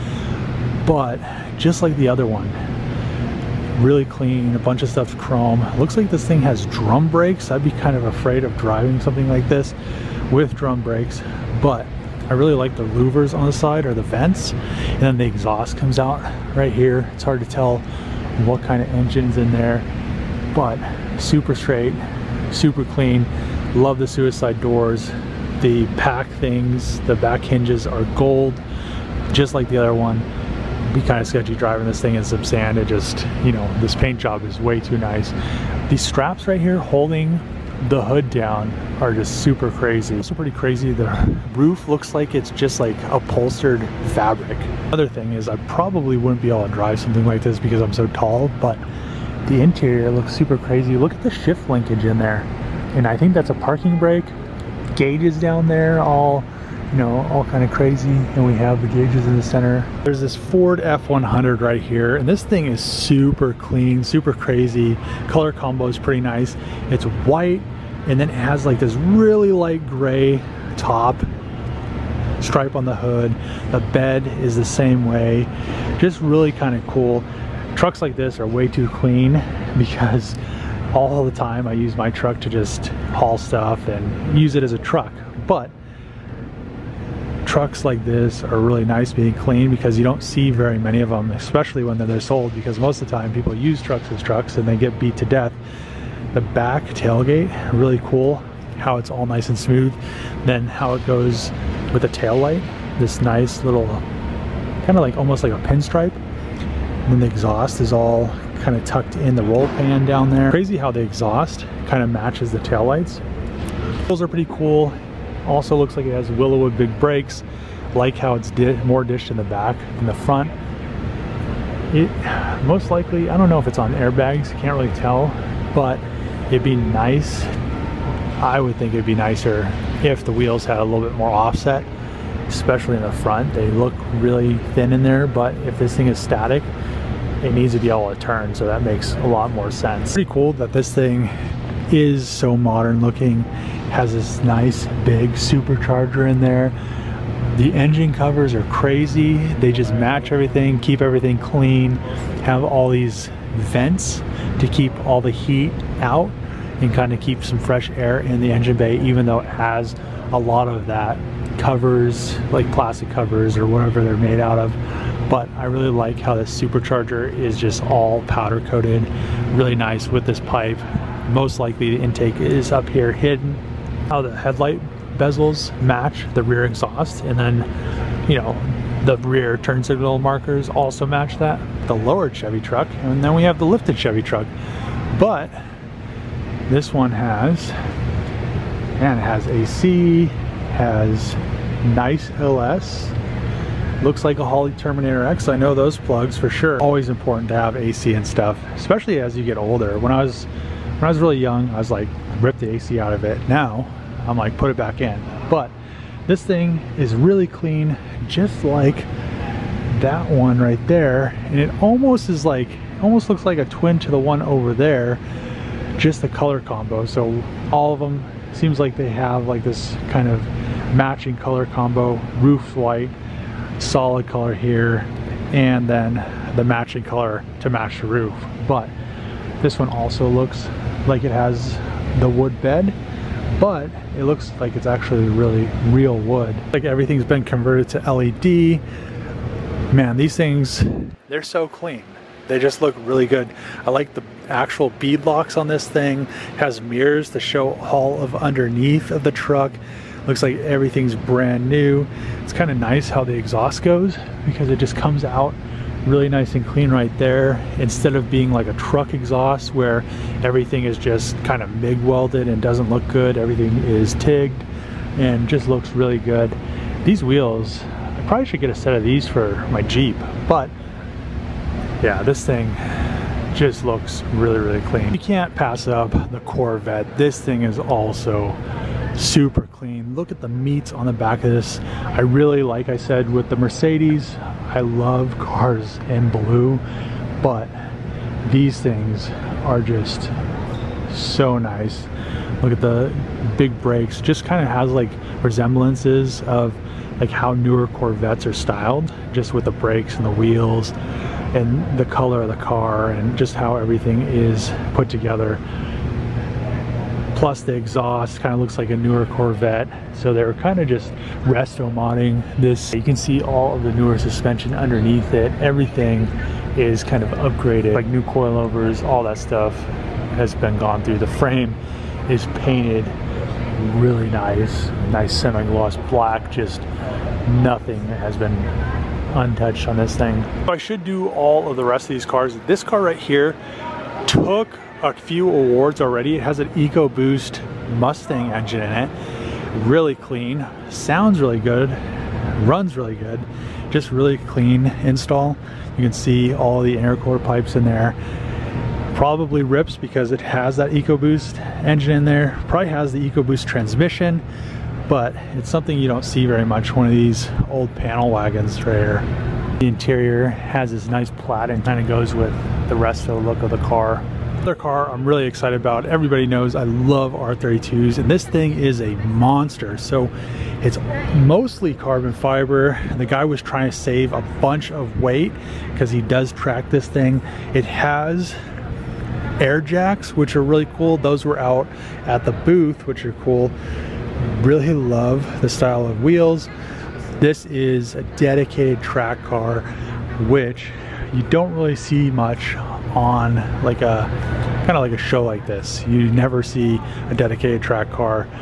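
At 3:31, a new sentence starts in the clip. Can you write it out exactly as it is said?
And it almost is like, almost looks like a twin to the one over there, just the color combo.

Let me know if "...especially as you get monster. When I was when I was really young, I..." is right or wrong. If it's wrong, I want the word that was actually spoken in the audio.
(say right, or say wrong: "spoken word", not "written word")
wrong: "older", not "monster".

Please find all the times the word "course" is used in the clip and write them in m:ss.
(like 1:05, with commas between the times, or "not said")
not said.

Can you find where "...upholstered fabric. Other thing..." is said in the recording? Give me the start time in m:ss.
0:43.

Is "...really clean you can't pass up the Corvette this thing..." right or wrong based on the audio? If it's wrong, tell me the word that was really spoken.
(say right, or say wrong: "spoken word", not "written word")
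right.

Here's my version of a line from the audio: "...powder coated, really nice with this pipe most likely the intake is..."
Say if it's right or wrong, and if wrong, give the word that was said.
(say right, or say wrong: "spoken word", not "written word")
right.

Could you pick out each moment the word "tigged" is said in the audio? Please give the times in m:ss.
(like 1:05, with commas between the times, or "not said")
4:24.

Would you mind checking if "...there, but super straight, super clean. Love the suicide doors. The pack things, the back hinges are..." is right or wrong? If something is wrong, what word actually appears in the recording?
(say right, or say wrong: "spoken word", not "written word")
right.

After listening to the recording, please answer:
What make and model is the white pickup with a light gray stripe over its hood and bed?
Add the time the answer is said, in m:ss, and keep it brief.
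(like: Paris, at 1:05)
Ford F100, at 1:00.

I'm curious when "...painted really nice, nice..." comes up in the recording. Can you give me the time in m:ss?
5:22.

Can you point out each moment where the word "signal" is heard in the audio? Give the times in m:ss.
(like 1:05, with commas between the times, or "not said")
2:59.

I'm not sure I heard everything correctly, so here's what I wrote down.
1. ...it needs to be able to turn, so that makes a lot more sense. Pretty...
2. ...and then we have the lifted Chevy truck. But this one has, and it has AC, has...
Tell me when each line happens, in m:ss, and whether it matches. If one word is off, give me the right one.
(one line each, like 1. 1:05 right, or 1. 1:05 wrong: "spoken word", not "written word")
1. 2:17 right
2. 3:03 right.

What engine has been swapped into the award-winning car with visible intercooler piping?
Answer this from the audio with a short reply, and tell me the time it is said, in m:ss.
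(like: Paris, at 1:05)
EcoBoost Mustang engine, at 5:36.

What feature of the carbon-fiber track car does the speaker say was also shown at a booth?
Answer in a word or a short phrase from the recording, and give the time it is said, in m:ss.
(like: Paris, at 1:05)
Air jacks, at 6:19.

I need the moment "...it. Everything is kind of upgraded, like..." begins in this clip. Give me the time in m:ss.
5:15.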